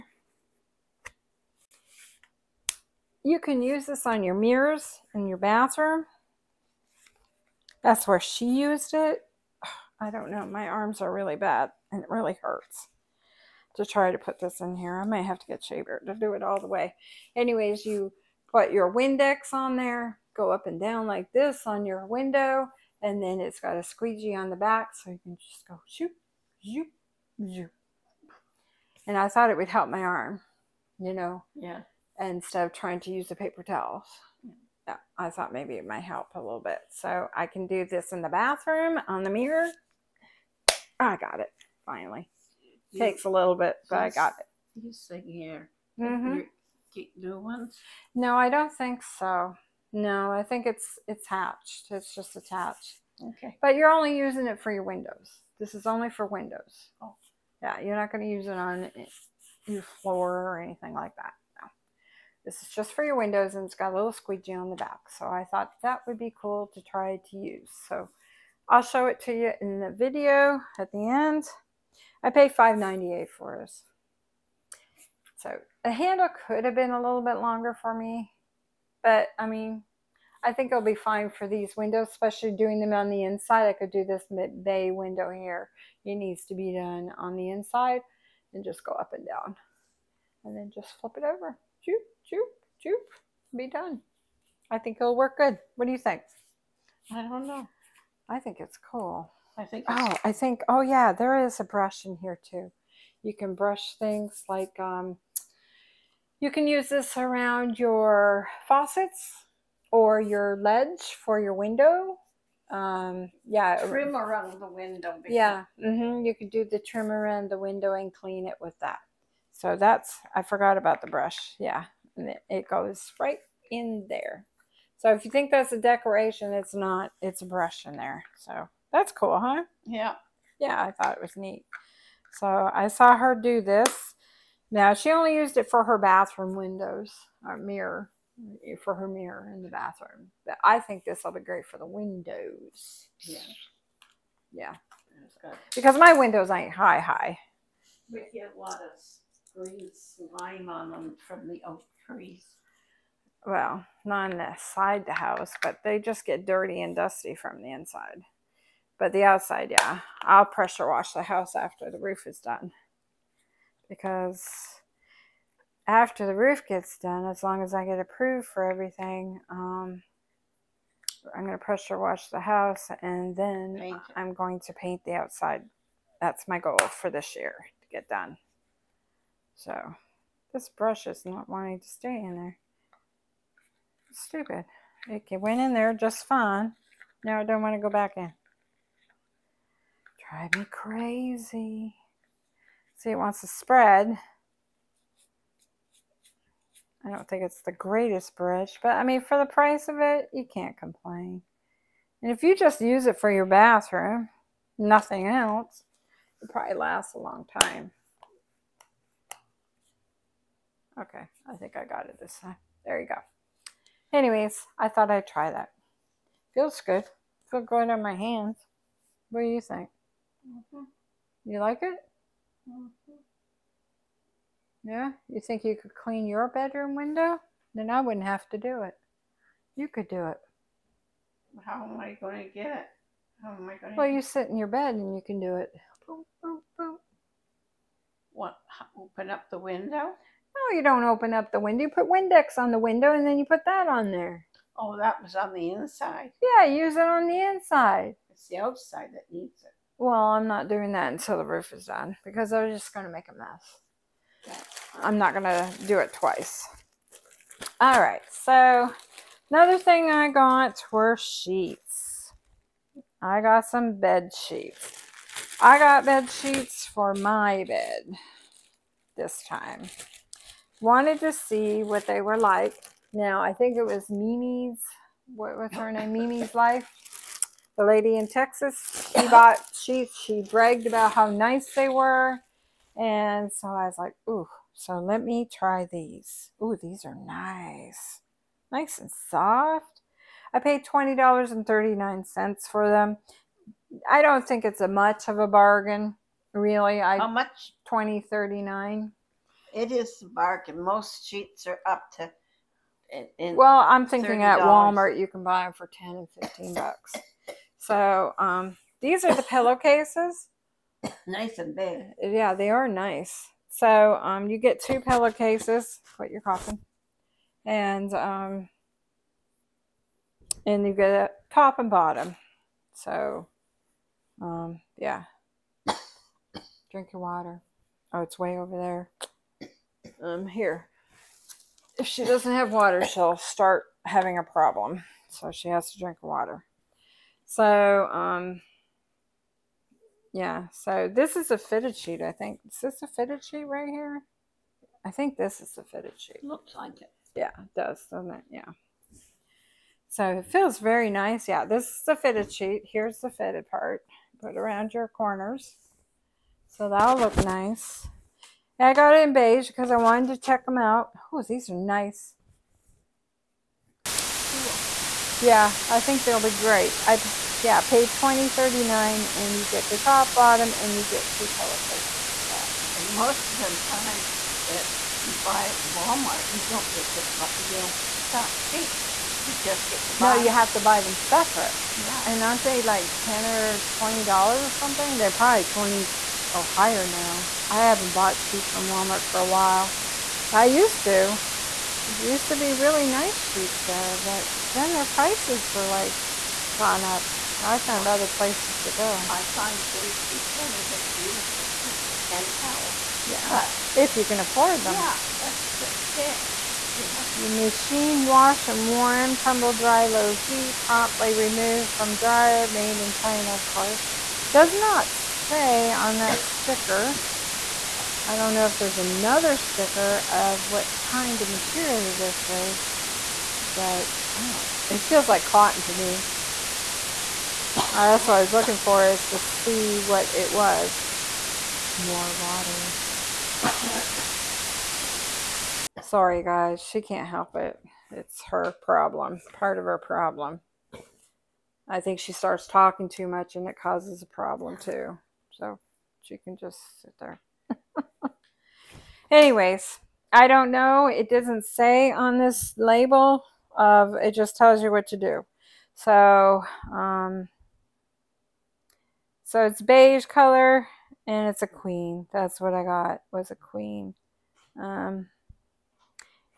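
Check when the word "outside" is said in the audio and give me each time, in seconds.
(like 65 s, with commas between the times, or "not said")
159 s, 175 s, 248 s.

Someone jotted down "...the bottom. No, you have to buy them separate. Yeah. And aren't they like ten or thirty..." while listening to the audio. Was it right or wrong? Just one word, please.
wrong.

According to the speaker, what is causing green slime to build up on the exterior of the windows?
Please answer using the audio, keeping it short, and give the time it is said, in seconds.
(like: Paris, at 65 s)
oak trees, at 151 s.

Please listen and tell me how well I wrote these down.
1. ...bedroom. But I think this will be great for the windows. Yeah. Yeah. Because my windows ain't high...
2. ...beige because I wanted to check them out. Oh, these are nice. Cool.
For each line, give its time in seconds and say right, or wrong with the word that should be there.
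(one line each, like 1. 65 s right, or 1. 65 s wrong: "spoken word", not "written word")
1. 139 s wrong: "bathroom", not "bedroom"
2. 359 s right.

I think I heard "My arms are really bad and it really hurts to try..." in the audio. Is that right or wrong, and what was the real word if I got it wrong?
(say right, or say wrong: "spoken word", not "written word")
right.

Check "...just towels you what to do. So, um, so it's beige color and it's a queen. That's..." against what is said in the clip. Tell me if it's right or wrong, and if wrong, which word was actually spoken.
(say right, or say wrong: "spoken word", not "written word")
wrong: "tells", not "towels".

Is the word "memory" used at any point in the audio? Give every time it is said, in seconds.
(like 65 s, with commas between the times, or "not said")
not said.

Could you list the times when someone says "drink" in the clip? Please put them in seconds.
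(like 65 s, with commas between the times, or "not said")
326 s, 335 s.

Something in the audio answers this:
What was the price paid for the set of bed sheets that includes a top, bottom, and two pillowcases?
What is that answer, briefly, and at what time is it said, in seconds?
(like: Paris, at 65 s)
$20.39, at 290 s.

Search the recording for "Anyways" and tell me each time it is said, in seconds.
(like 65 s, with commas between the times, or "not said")
17 s, 214 s, 449 s.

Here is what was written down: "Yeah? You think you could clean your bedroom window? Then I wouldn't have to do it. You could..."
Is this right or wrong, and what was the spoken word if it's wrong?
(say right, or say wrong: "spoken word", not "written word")
right.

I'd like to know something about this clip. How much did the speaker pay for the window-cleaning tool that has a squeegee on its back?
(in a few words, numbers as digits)
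$5.98.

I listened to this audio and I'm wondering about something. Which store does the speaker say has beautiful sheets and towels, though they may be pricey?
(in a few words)
J.C. Penney.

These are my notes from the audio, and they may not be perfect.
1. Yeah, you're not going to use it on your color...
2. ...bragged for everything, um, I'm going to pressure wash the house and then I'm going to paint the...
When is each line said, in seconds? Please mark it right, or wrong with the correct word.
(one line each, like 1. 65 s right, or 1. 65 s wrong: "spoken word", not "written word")
1. 57 s wrong: "floor", not "color"
2. 167 s wrong: "approved", not "bragged".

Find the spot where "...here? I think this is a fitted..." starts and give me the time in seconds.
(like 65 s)
343 s.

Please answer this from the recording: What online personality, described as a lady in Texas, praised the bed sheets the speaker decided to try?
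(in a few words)
Mimi's Life.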